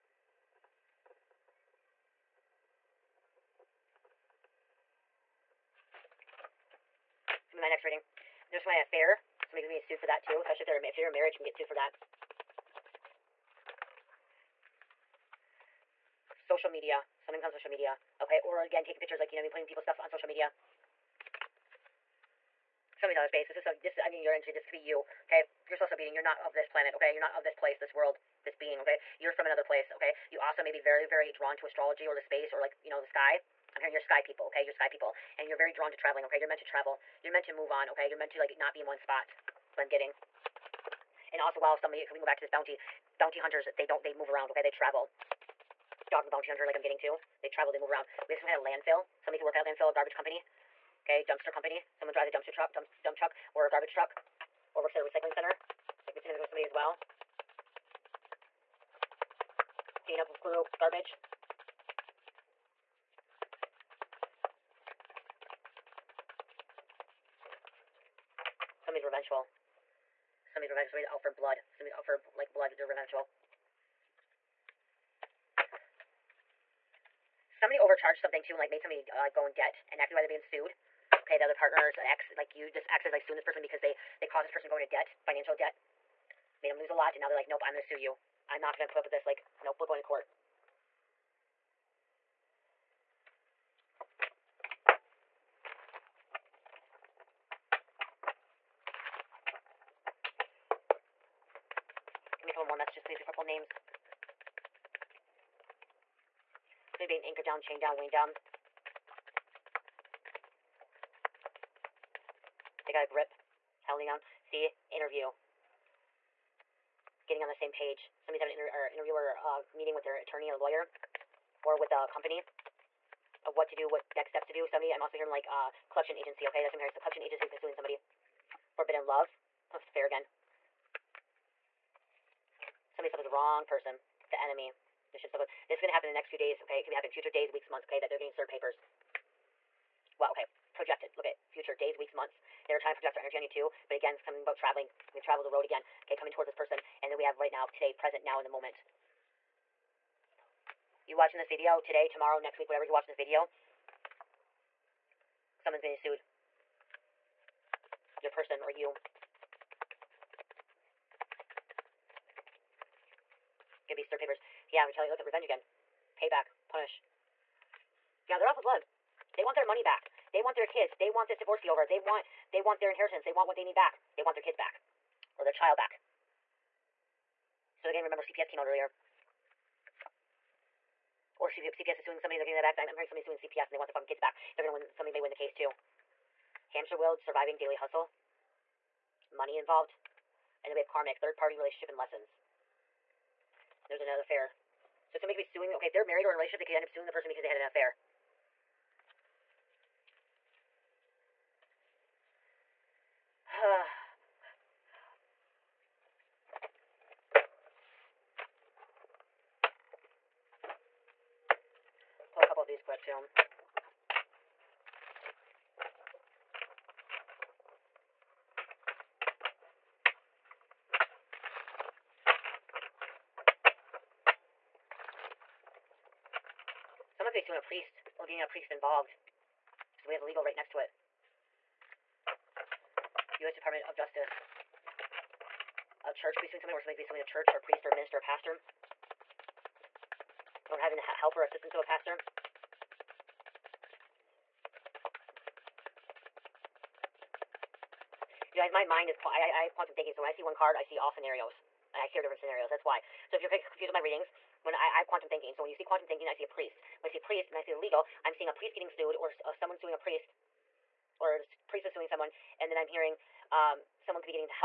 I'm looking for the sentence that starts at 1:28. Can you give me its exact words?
I'm not going to put up with this.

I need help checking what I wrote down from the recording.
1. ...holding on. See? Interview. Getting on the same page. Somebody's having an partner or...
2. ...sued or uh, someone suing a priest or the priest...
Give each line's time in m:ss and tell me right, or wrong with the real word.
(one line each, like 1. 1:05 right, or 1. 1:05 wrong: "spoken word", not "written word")
1. 1:53 wrong: "inter", not "partner"
2. 4:18 right.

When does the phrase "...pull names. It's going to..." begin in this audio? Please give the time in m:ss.
1:43.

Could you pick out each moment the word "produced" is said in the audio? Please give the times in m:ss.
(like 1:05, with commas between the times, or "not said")
not said.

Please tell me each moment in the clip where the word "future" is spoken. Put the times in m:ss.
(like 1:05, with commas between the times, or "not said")
2:17, 2:21.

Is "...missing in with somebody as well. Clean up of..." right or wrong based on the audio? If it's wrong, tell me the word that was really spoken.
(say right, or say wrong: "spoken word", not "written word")
right.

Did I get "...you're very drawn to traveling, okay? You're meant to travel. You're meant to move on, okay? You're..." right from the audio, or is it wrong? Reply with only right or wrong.
right.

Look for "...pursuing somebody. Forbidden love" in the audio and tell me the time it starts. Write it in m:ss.
2:07.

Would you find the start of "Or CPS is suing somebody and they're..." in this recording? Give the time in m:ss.
3:01.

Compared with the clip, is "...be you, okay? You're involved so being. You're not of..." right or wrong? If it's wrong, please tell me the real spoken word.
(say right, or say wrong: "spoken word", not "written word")
wrong: "supposed", not "involved".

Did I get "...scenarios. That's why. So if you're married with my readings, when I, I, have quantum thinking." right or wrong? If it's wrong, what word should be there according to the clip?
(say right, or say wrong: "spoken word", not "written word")
wrong: "confused", not "married".